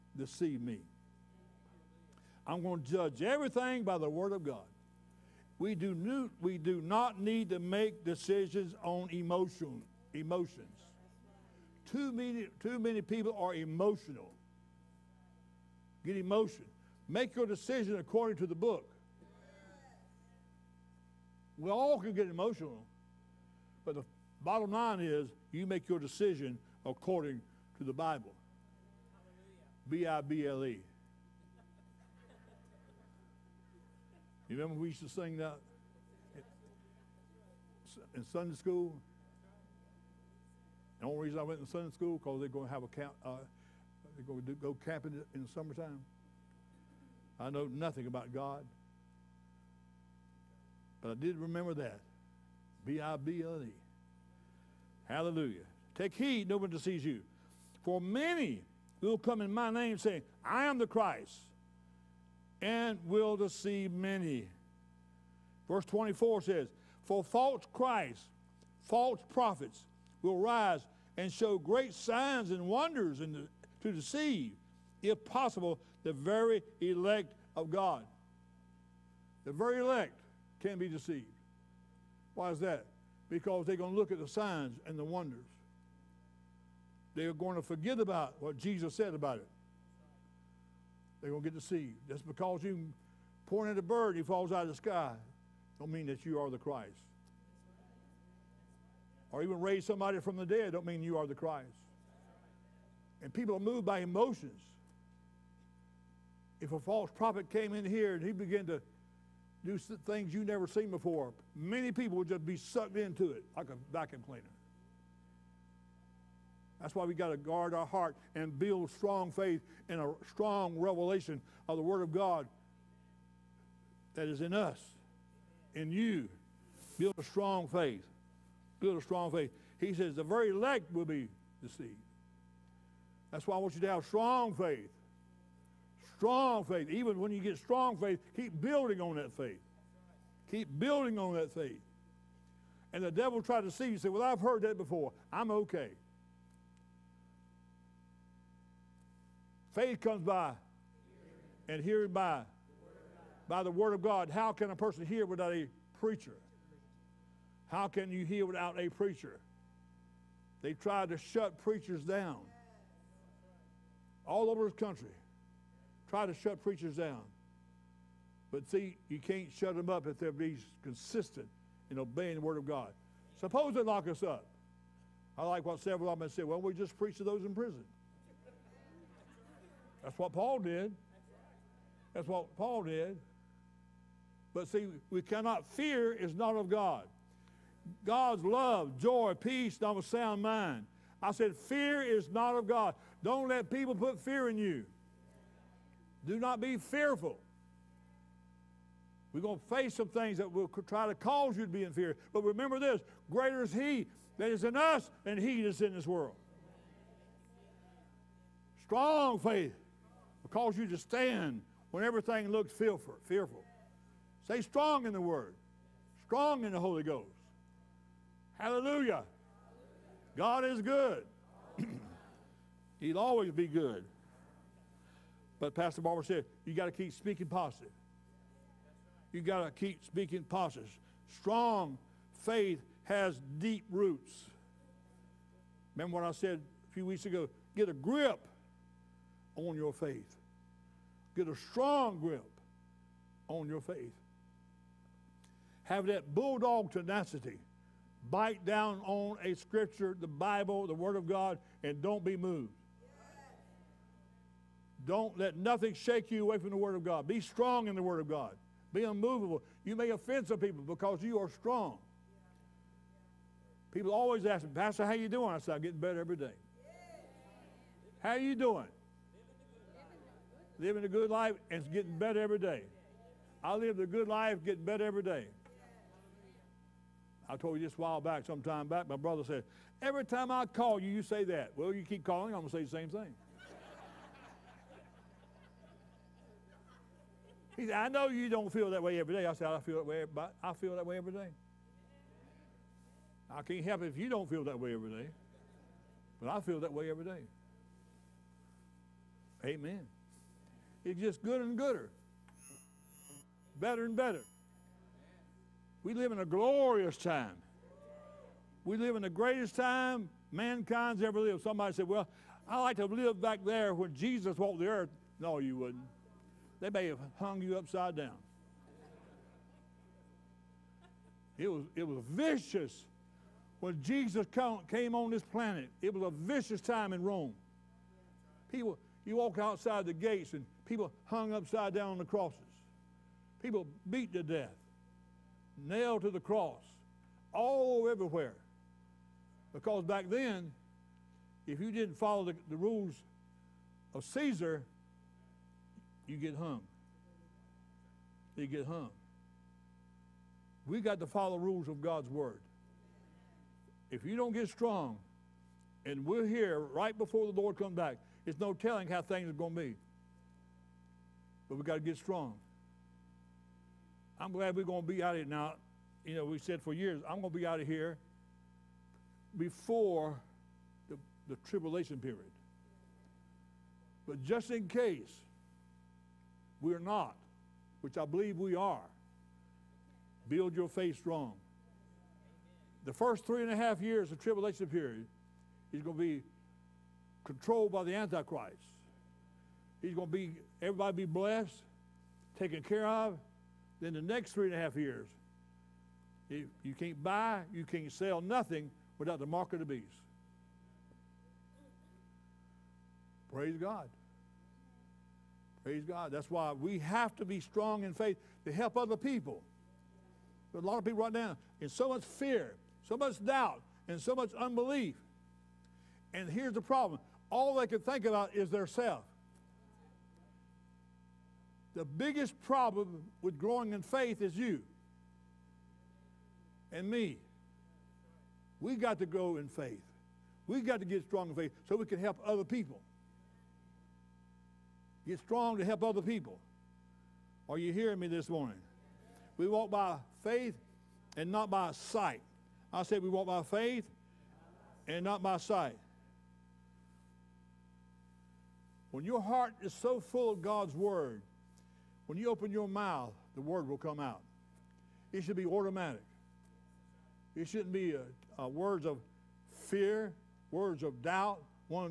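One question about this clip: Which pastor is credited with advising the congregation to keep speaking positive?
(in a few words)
Pastor Barber.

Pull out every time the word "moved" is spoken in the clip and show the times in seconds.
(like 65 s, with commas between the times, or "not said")
103 s, 252 s.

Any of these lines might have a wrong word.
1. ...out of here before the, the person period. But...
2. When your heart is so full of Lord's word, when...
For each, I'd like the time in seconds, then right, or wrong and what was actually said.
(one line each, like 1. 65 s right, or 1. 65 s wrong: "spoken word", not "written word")
1. 367 s wrong: "tribulation", not "person"
2. 449 s wrong: "God", not "Lord".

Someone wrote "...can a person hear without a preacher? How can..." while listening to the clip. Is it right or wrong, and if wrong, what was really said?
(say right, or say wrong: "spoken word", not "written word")
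right.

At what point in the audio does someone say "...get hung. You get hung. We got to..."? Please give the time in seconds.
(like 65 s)
346 s.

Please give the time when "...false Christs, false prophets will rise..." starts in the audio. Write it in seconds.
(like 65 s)
67 s.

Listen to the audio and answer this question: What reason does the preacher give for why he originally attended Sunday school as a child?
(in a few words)
Camping in the summertime.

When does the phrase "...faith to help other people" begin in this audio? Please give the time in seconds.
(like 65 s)
408 s.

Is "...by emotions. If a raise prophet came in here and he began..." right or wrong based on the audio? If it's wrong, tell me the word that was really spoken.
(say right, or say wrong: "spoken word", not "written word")
wrong: "false", not "raise".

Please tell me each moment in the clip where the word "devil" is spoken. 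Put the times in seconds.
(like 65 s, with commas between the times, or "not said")
143 s.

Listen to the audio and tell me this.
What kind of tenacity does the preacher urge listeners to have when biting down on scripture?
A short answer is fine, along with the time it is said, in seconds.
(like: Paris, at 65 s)
Bulldog tenacity, at 246 s.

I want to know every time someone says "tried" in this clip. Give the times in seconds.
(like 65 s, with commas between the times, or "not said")
143 s, 160 s.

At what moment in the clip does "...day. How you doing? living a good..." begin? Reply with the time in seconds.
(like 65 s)
266 s.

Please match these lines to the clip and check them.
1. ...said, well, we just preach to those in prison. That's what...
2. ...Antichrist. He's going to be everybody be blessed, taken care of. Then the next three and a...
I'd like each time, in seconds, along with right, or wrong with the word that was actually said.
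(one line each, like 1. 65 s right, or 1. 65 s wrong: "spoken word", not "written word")
1. 176 s right
2. 388 s right.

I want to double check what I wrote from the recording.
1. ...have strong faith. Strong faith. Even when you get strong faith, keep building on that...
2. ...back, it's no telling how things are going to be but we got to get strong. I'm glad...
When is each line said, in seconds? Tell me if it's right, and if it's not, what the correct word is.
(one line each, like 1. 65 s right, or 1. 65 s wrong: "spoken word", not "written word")
1. 133 s right
2. 357 s right.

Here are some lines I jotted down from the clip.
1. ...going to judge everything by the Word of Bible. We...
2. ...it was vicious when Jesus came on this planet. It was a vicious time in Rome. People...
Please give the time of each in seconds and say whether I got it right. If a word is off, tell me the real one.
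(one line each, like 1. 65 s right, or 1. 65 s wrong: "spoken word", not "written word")
1. 2 s wrong: "God", not "Bible"
2. 321 s right.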